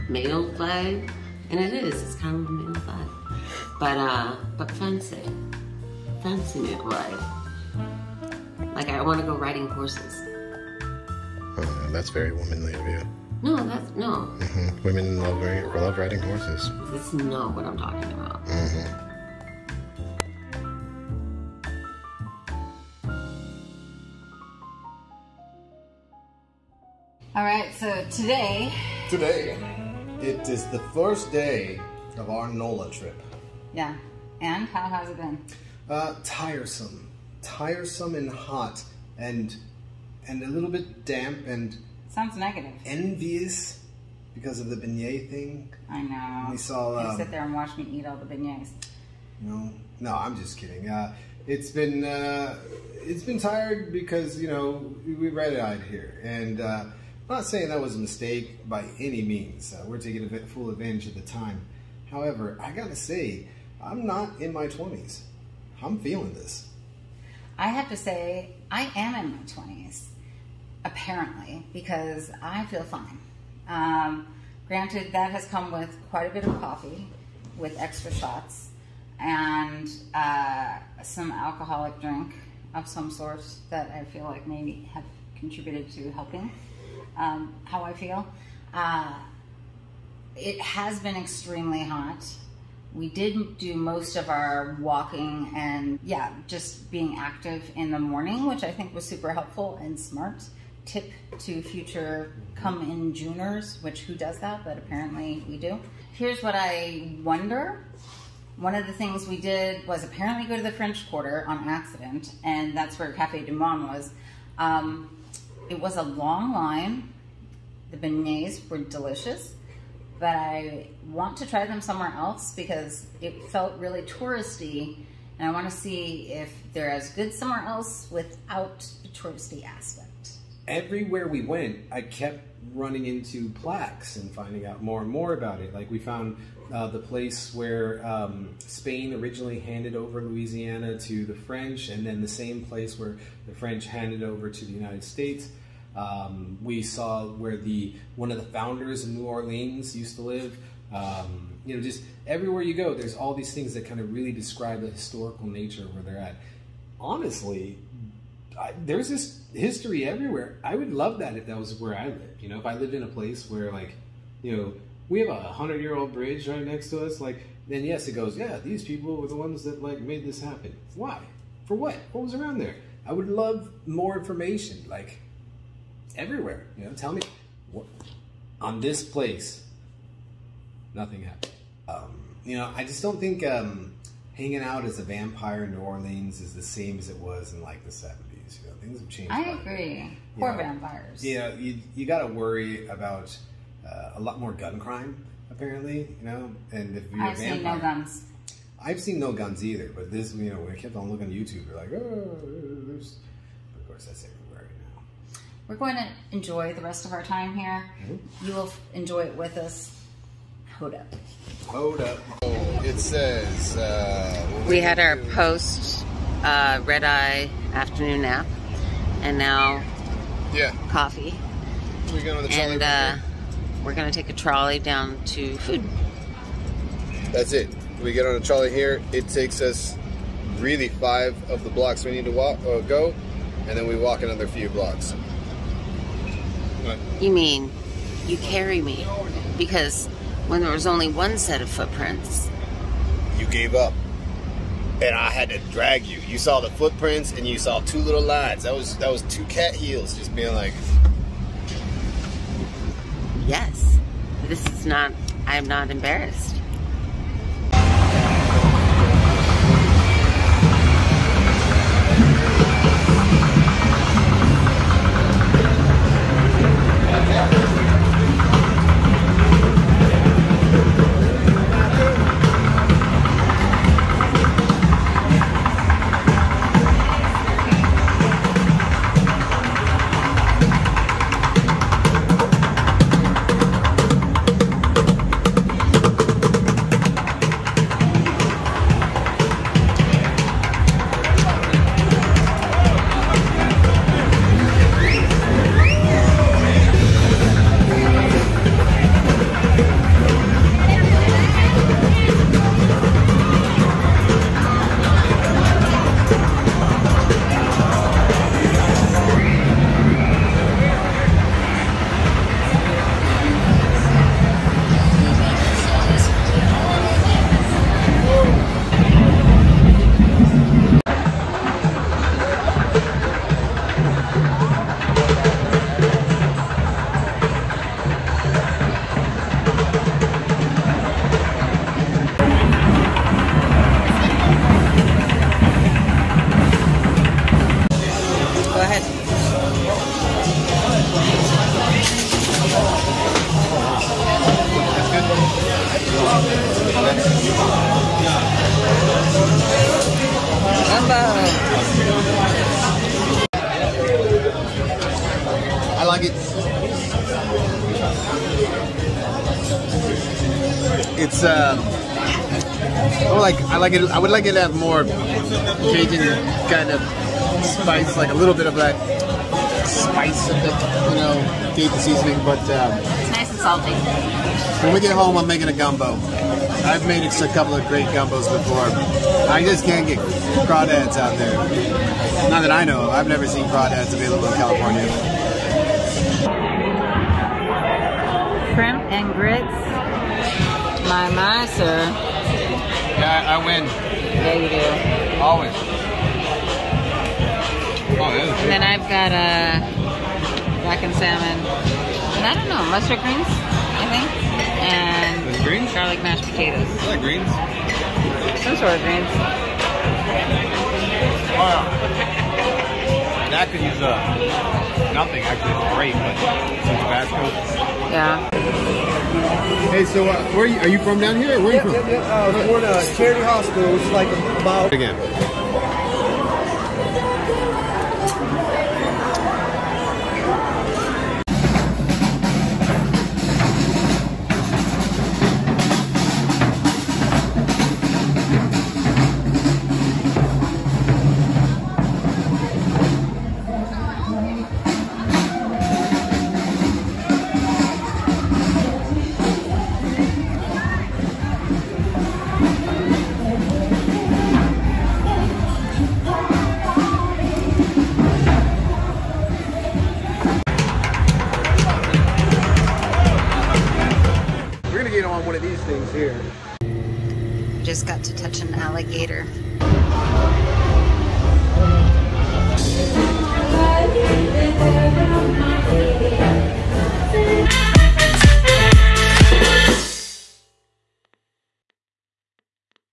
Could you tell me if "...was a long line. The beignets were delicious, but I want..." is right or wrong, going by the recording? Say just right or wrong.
right.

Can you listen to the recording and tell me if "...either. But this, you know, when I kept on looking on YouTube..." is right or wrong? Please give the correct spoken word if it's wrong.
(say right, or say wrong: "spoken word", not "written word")
right.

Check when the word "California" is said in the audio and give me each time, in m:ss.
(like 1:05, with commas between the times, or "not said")
6:24.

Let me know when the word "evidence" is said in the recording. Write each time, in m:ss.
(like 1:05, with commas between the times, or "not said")
not said.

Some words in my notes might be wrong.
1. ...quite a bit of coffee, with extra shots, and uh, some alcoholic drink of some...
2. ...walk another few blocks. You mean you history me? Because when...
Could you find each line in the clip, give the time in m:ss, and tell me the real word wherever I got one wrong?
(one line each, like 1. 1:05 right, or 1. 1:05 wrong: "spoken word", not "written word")
1. 1:16 right
2. 3:53 wrong: "carry", not "history".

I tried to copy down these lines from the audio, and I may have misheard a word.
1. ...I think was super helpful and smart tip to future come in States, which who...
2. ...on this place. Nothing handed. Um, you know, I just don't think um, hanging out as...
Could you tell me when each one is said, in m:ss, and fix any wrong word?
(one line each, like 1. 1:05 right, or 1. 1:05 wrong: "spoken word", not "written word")
1. 1:38 wrong: "Juners", not "States"
2. 2:58 wrong: "happened", not "handed".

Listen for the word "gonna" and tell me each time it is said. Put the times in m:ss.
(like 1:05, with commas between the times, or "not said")
3:43.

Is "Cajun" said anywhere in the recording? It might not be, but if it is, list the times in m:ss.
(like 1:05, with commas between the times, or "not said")
6:05, 6:11.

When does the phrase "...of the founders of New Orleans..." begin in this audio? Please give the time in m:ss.
2:28.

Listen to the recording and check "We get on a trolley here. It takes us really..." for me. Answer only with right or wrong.
right.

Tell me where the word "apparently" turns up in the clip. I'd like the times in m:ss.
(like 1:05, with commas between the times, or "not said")
1:10, 1:44, 1:50, 3:15.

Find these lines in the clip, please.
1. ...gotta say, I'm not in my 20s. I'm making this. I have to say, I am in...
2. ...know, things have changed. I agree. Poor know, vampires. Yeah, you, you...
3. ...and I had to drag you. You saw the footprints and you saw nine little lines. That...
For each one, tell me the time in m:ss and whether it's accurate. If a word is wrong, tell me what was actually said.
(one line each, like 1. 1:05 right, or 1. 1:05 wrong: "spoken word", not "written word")
1. 1:02 wrong: "feeling", not "making"
2. 3:08 right
3. 4:05 wrong: "two", not "nine".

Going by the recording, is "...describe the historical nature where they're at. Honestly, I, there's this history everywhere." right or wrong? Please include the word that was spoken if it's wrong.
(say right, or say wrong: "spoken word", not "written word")
right.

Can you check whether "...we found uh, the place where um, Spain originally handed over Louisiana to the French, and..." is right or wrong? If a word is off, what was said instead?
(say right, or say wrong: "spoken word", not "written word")
right.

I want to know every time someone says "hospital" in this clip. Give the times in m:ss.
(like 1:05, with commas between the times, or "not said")
7:03.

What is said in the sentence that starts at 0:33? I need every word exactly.
Yeah, and how has it been?